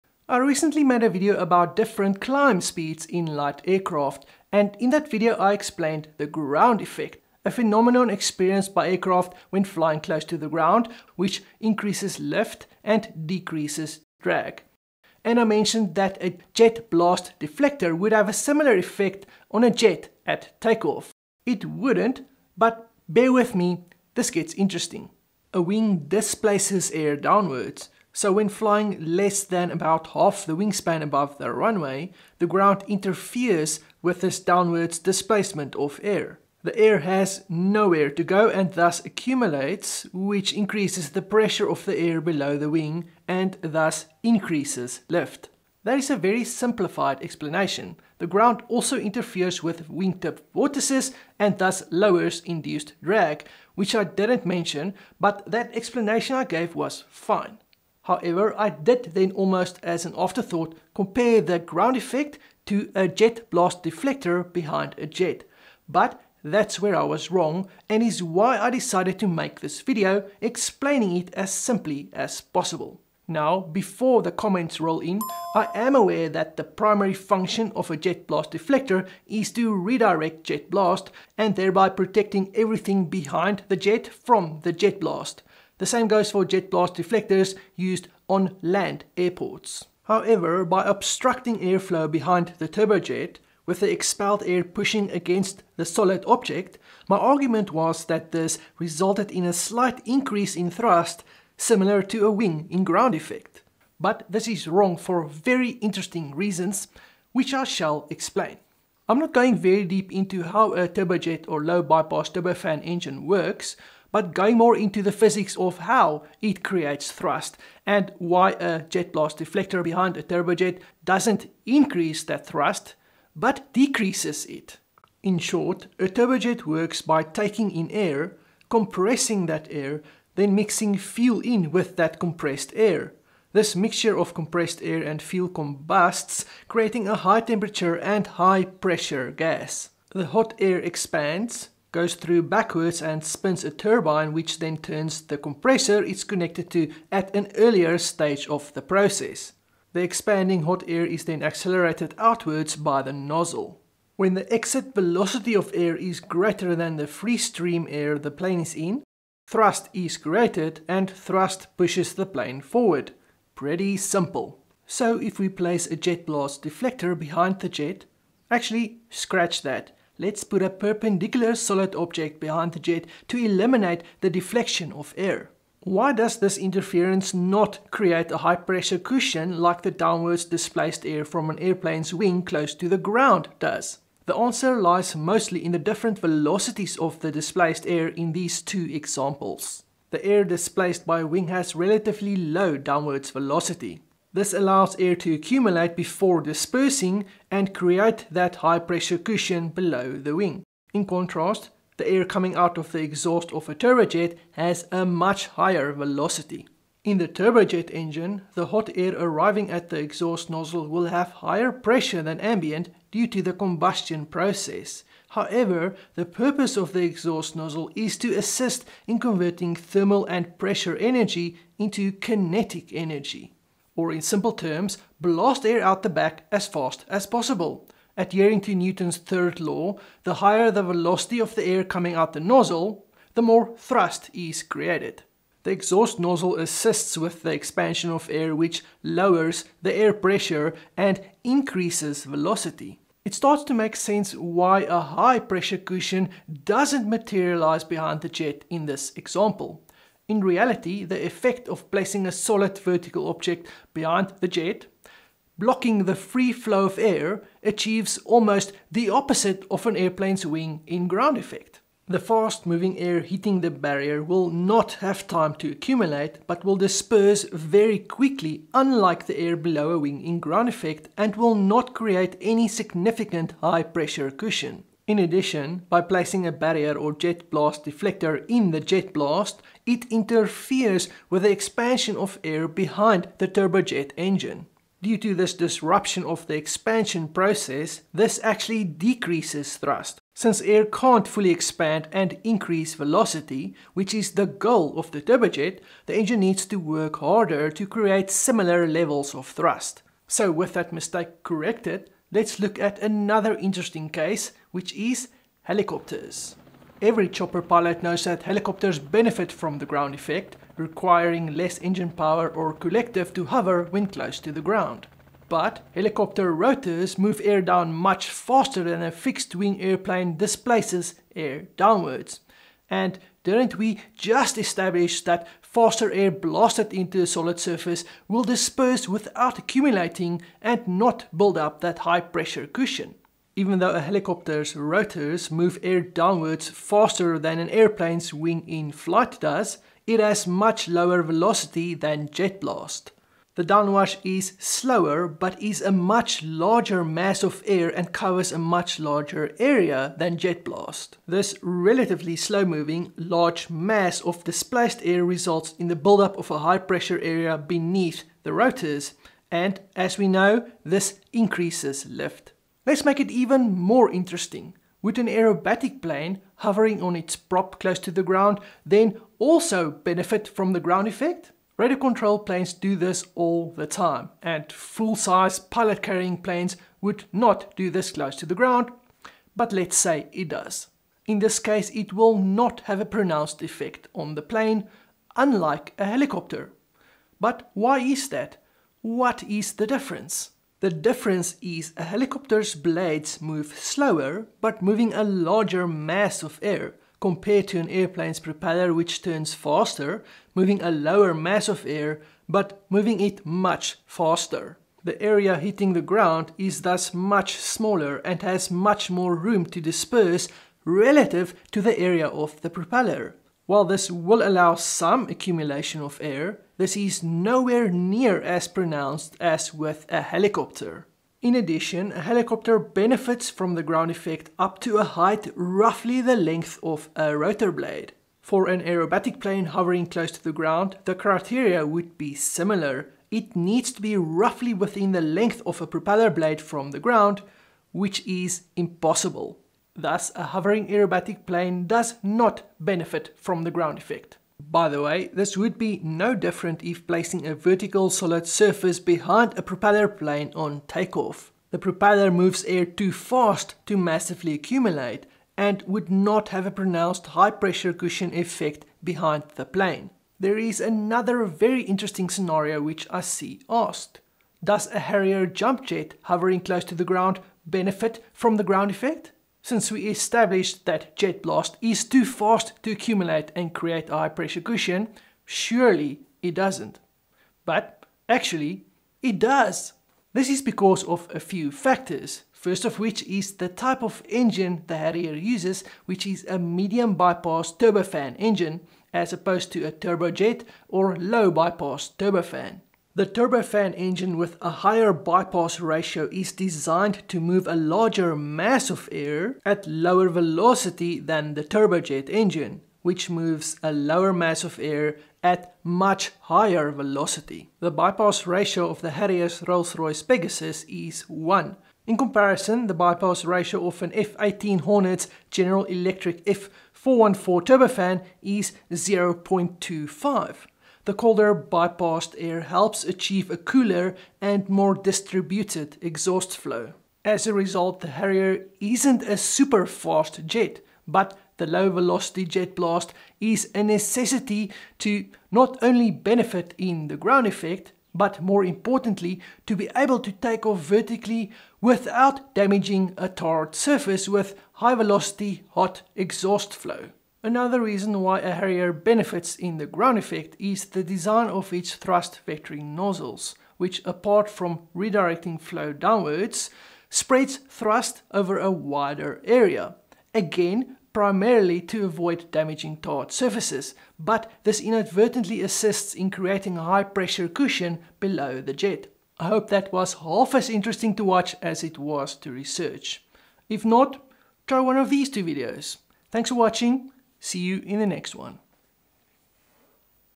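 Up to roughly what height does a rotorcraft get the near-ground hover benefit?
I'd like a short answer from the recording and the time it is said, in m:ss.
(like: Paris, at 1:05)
length of a rotor blade, at 7:06.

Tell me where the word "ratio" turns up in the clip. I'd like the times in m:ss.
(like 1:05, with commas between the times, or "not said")
8:15, 8:28, 8:33.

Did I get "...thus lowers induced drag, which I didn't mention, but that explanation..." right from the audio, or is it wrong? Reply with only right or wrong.
right.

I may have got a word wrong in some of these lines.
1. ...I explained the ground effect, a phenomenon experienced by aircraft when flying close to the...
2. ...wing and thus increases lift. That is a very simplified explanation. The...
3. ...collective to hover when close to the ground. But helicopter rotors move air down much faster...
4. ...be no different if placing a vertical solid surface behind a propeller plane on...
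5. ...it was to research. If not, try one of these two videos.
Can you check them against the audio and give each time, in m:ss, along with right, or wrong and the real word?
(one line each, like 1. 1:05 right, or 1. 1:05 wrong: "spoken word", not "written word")
1. 0:05 right
2. 0:42 right
3. 5:12 right
4. 7:25 right
5. 9:31 right.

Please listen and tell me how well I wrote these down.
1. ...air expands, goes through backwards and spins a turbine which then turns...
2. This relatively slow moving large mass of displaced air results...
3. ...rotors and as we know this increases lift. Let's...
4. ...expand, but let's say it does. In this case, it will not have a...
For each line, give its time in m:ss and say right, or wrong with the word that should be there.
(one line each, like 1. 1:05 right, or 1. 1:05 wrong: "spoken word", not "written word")
1. 2:20 right
2. 5:51 right
3. 5:58 right
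4. 6:18 wrong: "ground", not "expand".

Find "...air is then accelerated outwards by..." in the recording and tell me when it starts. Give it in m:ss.
2:30.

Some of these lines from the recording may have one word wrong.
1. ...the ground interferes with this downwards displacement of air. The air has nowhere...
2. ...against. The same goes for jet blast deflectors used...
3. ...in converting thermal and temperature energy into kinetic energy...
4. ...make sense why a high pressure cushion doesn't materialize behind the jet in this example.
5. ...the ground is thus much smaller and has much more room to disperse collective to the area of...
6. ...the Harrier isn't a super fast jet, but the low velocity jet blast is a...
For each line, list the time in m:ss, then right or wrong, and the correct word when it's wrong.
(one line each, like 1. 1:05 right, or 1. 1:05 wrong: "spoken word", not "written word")
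1. 0:32 right
2. 1:25 wrong: "blast", not "against"
3. 3:39 wrong: "pressure", not "temperature"
4. 4:03 right
5. 6:45 wrong: "relative", not "collective"
6. 8:48 right.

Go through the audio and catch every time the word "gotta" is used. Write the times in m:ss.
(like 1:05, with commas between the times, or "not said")
not said.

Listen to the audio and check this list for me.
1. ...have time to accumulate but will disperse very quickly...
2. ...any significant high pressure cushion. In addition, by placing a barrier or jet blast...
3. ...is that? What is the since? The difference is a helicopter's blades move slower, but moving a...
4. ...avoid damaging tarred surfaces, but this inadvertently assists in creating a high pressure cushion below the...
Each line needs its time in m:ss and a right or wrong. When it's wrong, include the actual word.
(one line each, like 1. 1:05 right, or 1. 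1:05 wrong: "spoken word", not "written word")
1. 4:25 right
2. 4:32 right
3. 6:27 wrong: "difference", not "since"
4. 9:22 right.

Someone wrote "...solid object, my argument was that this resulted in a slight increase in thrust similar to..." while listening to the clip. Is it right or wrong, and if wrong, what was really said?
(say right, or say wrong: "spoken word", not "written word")
right.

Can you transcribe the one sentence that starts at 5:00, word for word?
So with that mistake corrected, let's look at another interesting case, which is helicopters.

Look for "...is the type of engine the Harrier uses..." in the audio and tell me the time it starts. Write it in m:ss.
8:03.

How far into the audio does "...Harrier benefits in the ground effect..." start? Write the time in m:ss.
9:08.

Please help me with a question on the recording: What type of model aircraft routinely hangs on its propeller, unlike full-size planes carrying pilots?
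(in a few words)
Radio control planes.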